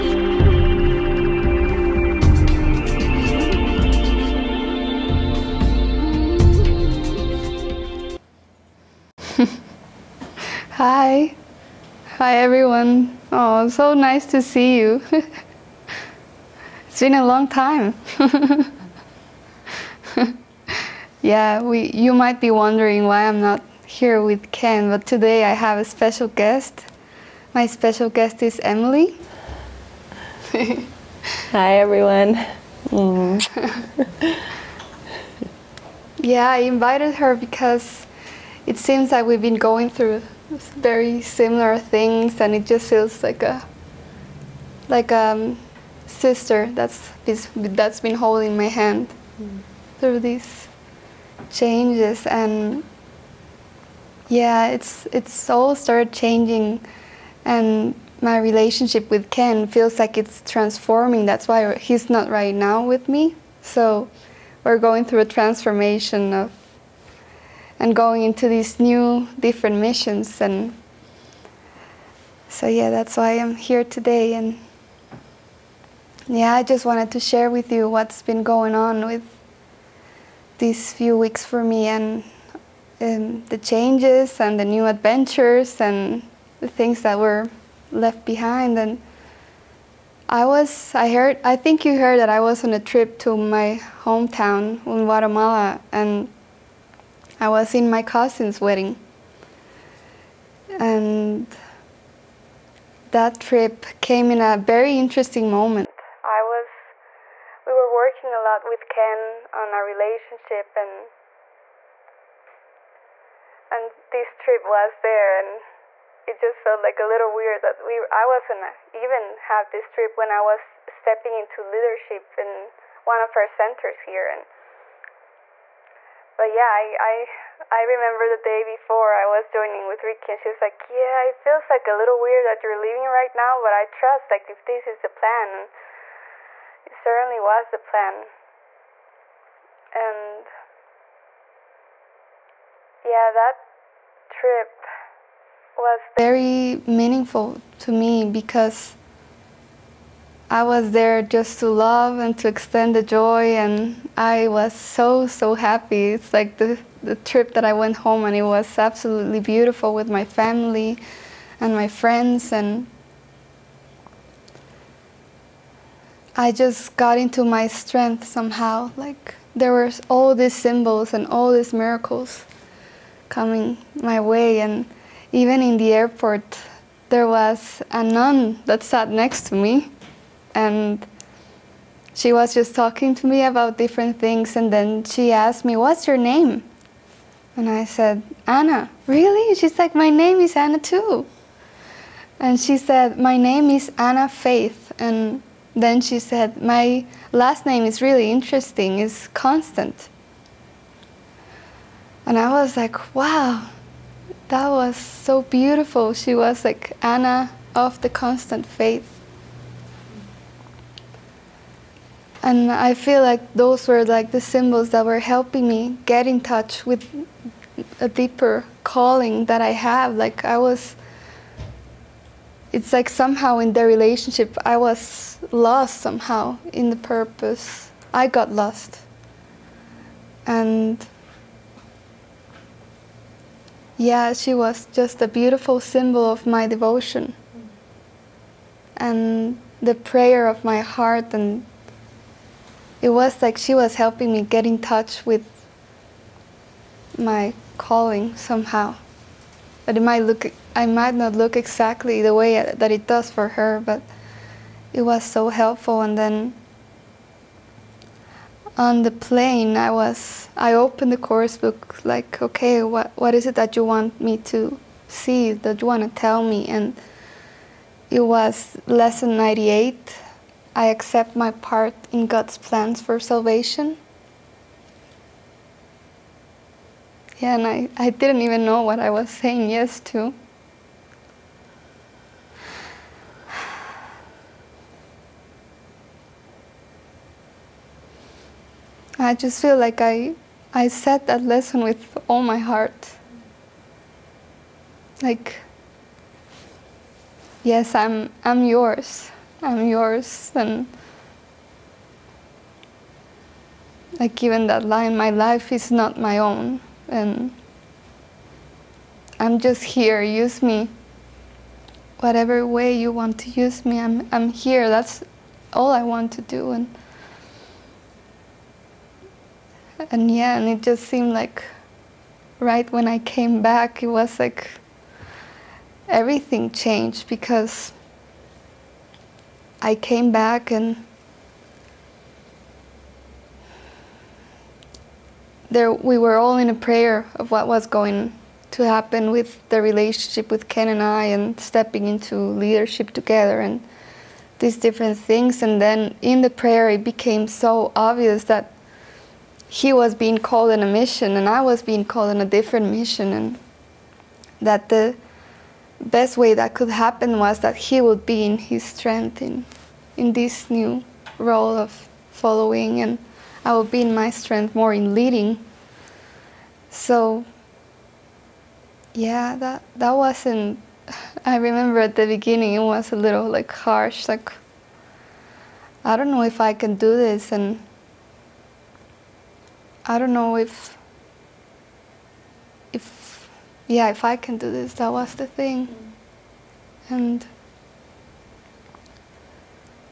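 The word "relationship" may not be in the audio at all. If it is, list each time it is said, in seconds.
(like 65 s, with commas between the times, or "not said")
58 s, 109 s, 223 s, 339 s.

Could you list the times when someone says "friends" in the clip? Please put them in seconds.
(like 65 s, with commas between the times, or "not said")
161 s.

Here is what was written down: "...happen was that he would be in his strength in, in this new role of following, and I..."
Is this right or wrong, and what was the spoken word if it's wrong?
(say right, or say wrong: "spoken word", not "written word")
right.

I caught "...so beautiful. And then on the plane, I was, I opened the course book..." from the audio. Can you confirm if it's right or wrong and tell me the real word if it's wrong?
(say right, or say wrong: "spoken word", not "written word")
wrong: "helpful", not "beautiful".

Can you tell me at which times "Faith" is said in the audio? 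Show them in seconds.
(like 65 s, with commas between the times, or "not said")
194 s, 208 s.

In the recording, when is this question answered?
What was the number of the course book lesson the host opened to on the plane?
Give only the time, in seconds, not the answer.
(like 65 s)
269 s.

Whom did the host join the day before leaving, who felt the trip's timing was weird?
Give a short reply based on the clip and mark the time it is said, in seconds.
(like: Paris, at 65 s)
Ricky, at 130 s.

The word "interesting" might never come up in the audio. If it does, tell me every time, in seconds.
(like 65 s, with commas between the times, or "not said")
104 s, 198 s.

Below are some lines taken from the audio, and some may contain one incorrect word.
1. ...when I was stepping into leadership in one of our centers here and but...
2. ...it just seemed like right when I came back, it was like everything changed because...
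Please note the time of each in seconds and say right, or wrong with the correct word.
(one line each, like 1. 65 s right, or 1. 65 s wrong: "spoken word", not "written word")
1. 120 s right
2. 320 s right.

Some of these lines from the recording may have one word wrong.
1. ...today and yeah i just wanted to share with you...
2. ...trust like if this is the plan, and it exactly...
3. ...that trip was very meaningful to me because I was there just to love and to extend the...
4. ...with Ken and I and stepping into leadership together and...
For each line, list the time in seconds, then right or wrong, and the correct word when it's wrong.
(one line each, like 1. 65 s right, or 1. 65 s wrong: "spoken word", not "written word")
1. 73 s right
2. 133 s wrong: "certainly", not "exactly"
3. 143 s right
4. 340 s right.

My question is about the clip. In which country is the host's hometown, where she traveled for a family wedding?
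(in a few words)
Guatemala.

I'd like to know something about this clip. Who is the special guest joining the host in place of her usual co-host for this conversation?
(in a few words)
Emily.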